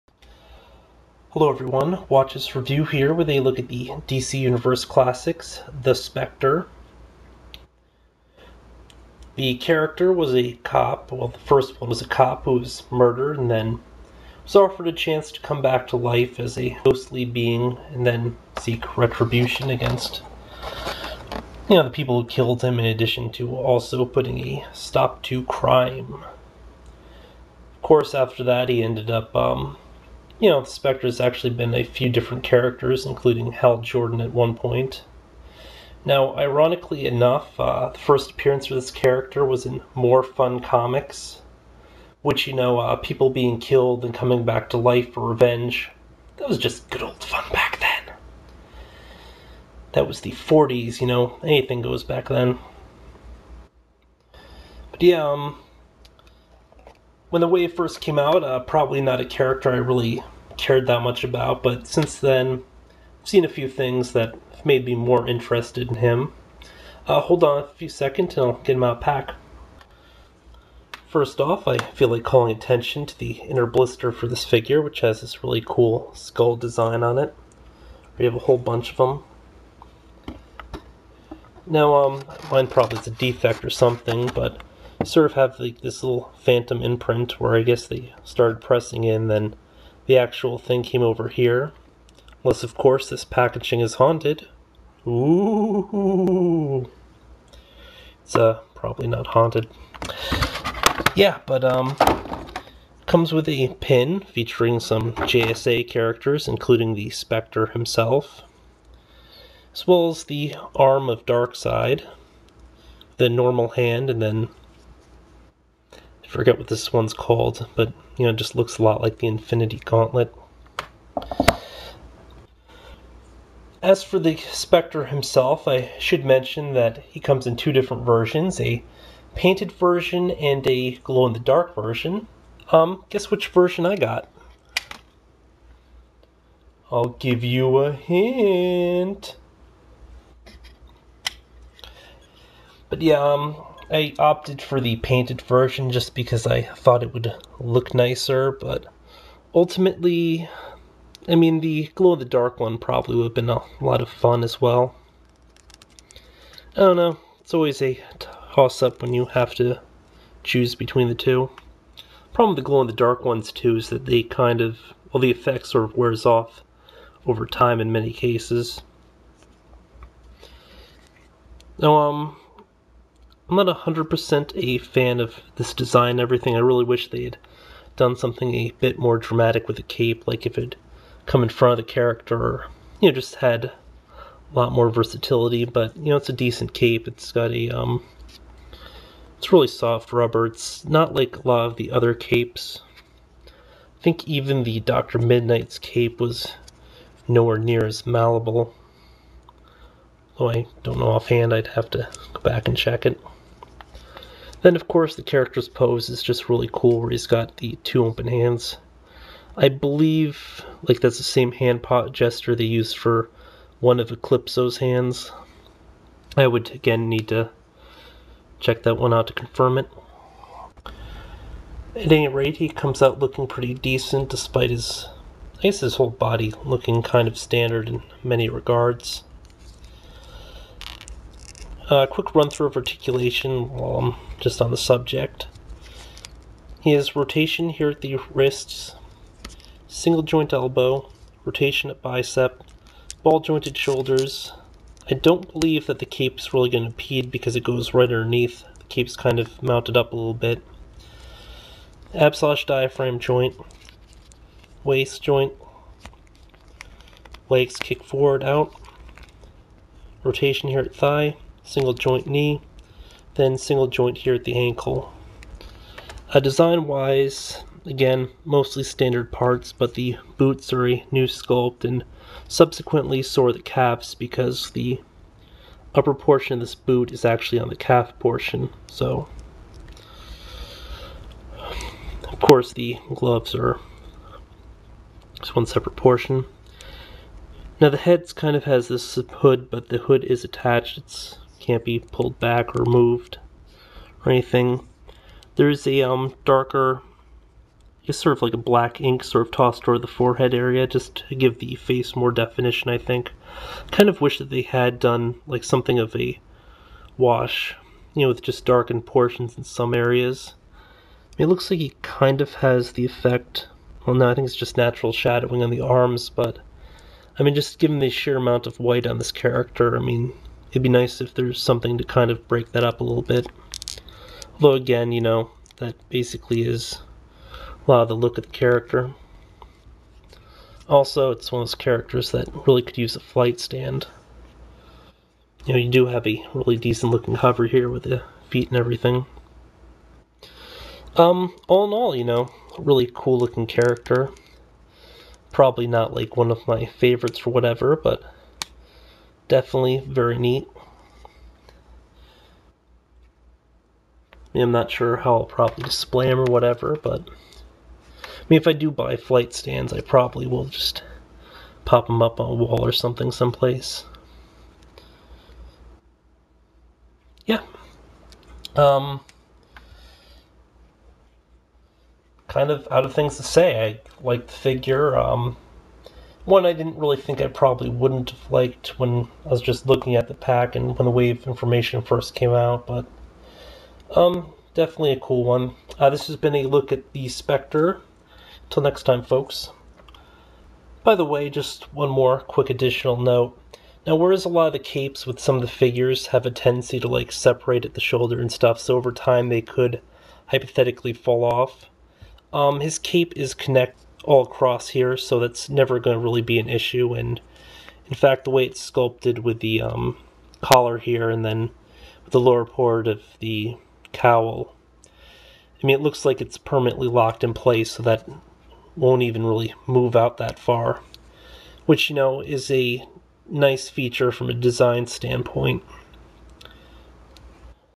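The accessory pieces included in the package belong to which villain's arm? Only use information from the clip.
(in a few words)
Darkseid.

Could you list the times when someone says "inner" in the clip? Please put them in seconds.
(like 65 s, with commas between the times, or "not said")
73 s.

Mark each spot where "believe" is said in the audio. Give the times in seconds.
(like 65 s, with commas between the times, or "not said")
209 s, 245 s.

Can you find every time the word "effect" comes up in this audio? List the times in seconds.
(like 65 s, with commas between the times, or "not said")
165 s, 313 s.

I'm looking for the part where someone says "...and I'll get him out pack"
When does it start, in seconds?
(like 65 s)
68 s.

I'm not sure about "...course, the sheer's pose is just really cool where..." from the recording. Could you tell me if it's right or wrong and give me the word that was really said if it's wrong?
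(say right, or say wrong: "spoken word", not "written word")
wrong: "character", not "sheer".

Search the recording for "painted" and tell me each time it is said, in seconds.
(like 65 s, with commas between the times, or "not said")
129 s, 144 s.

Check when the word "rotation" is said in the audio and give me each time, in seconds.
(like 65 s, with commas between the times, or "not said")
237 s, 241 s, 260 s.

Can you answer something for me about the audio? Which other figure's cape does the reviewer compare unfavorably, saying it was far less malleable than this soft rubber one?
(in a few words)
Dr. Midnight.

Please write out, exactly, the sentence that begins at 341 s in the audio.
Um, all in all, you know, really cool looking character.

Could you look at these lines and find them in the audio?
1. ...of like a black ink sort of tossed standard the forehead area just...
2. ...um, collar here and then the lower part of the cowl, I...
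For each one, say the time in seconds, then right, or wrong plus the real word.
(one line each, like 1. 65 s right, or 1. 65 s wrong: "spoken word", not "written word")
1. 298 s wrong: "toward", not "standard"
2. 409 s right.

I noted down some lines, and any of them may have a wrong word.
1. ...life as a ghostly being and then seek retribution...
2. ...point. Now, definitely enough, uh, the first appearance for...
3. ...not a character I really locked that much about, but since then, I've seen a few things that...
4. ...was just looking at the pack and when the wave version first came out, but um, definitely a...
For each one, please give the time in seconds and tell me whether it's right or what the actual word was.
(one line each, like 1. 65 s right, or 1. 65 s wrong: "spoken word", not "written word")
1. 15 s right
2. 34 s wrong: "ironically", not "definitely"
3. 59 s wrong: "cared", not "locked"
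4. 379 s wrong: "information", not "version".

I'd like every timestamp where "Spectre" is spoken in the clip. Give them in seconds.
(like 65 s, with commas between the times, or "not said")
5 s, 30 s, 107 s, 124 s, 387 s.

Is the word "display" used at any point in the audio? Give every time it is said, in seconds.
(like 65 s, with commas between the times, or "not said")
355 s.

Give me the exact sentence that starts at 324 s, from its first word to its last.
Although, again, you know, that basically is a lot of the look of the character.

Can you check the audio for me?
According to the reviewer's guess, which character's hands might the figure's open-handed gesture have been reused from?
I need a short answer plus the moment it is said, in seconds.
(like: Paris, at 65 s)
Eclipso, at 214 s.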